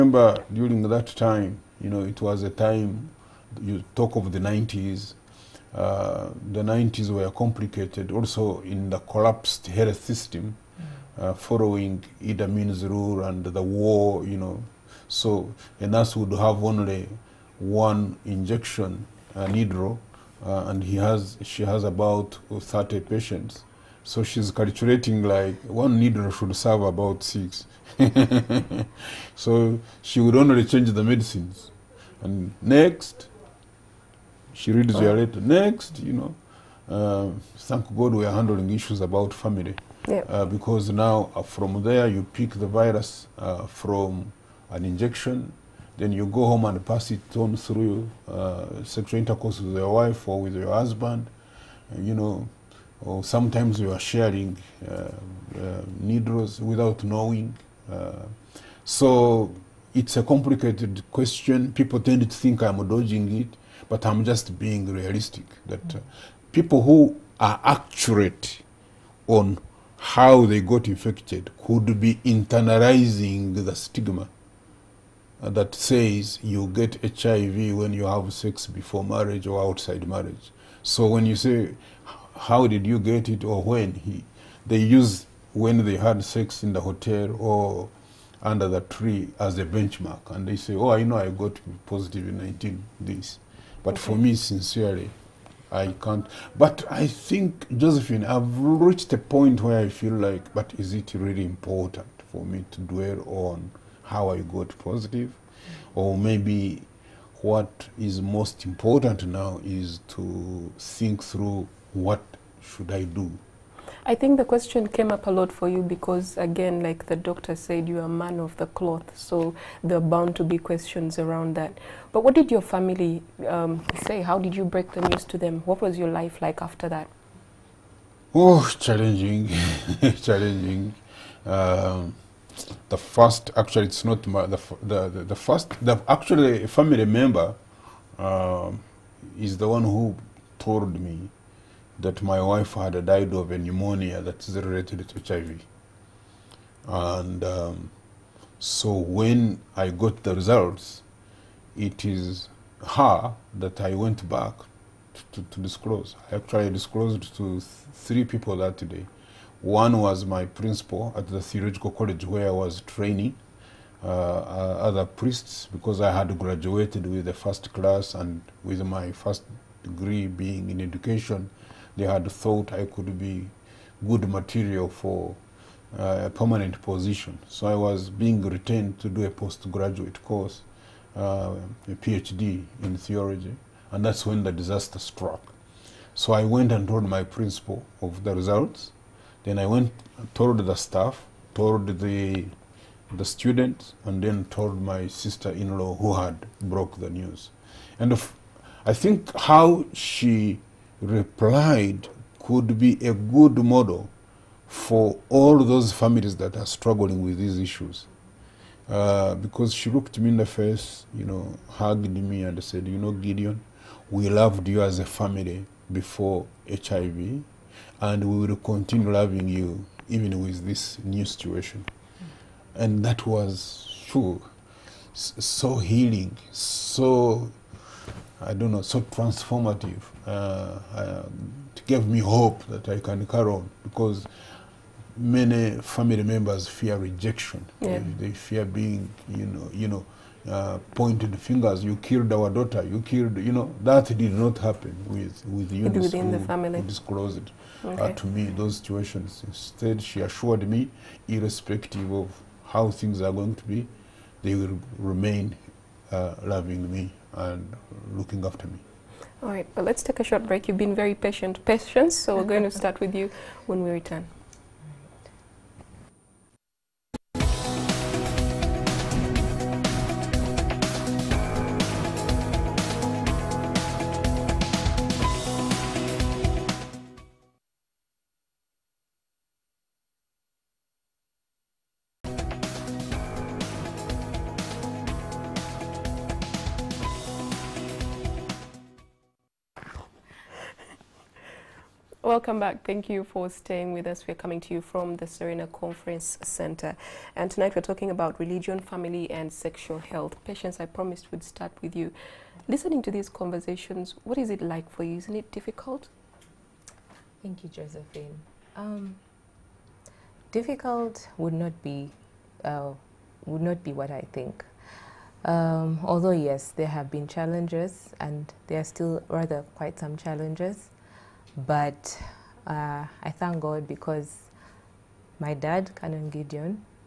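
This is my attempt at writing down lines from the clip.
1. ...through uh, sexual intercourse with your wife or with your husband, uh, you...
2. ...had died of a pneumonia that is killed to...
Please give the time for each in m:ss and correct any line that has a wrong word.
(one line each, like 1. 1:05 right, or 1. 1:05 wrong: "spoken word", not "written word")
1. 0:47 right
2. 2:22 wrong: "related", not "killed".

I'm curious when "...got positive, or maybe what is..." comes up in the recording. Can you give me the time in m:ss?
1:44.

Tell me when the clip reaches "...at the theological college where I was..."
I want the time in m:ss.
2:41.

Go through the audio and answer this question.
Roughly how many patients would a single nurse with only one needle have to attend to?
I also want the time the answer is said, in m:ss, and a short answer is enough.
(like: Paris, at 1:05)
30, at 0:22.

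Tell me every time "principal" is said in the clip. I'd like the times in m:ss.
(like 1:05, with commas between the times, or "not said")
2:40, 3:07.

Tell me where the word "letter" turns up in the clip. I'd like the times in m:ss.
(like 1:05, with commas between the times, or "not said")
0:35.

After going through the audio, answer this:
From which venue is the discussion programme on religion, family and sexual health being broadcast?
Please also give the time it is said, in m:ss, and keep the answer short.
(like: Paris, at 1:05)
Serena Conference Center, at 4:55.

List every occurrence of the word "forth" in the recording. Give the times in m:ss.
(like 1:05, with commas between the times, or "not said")
not said.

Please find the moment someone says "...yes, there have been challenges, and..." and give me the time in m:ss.
5:16.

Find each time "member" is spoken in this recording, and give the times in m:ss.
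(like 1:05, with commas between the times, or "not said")
2:17, 3:56.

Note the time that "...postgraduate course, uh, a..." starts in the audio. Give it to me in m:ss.
2:59.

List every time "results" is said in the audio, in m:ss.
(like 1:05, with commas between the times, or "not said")
2:30, 3:08.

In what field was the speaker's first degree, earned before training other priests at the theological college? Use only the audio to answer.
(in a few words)
Education.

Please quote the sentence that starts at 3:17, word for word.
And I think how she replied could be a good model for all those families that are struggling with these issues.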